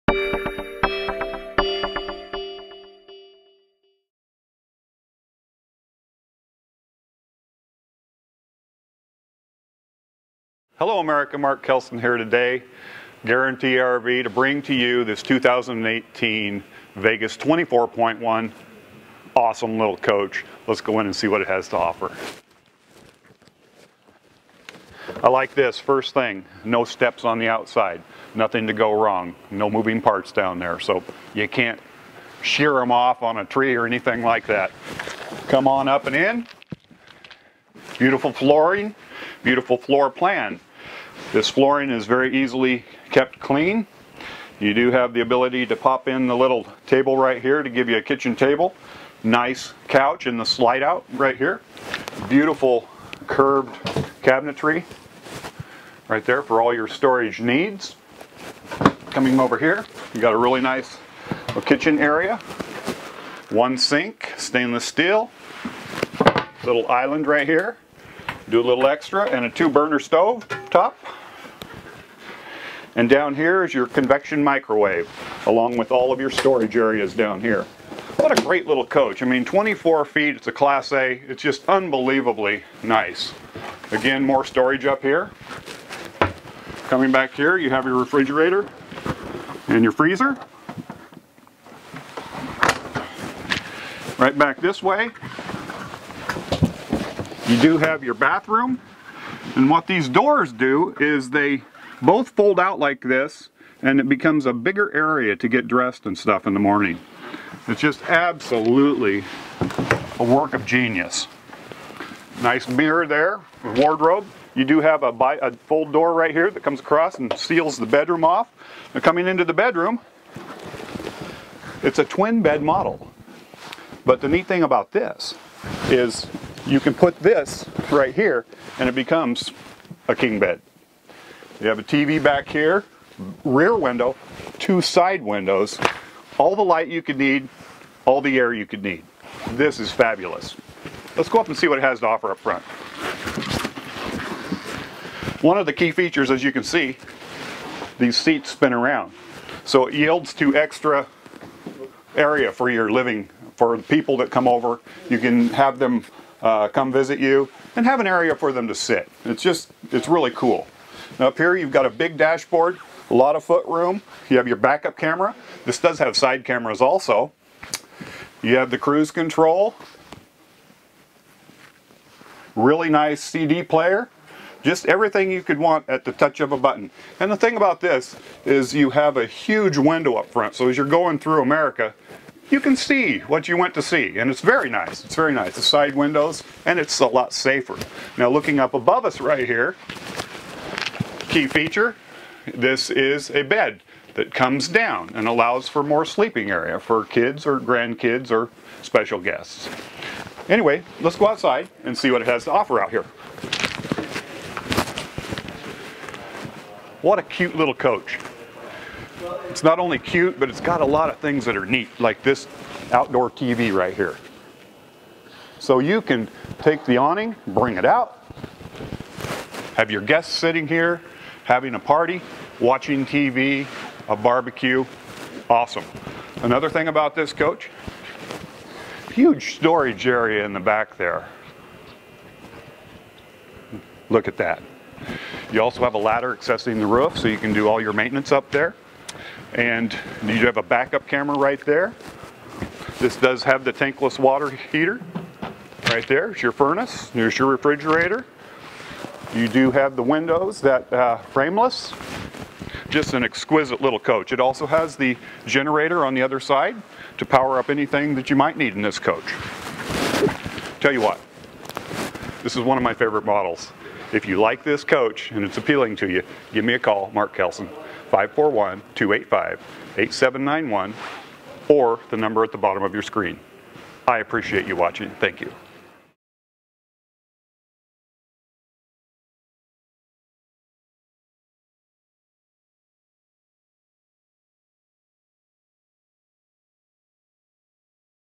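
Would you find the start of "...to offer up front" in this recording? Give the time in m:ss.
2:21.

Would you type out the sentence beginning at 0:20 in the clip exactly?
Let's go in and see what it has to offer.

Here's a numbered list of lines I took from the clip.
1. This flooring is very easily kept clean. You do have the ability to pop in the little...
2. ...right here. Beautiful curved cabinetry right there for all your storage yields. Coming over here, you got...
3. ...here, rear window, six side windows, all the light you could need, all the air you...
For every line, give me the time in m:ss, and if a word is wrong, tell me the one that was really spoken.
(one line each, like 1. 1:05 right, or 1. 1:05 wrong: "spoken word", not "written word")
1. 0:41 right
2. 0:51 wrong: "needs", not "yields"
3. 2:12 wrong: "two", not "six".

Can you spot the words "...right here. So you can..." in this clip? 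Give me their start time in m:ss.
3:33.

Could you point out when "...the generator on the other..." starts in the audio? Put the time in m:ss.
4:14.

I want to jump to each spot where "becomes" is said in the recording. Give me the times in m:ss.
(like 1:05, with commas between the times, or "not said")
1:44, 2:08.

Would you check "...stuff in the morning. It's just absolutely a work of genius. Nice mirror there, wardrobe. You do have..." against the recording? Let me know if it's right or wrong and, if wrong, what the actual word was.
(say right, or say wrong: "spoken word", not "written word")
right.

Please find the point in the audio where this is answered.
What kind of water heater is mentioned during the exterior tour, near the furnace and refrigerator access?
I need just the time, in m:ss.
4:03.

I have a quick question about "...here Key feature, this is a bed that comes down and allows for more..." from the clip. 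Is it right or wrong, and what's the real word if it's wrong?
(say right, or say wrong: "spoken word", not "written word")
right.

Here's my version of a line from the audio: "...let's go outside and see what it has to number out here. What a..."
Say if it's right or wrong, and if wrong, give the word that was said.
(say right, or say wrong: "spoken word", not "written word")
wrong: "offer", not "number".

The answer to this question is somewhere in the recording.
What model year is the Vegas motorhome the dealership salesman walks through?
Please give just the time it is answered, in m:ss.
0:15.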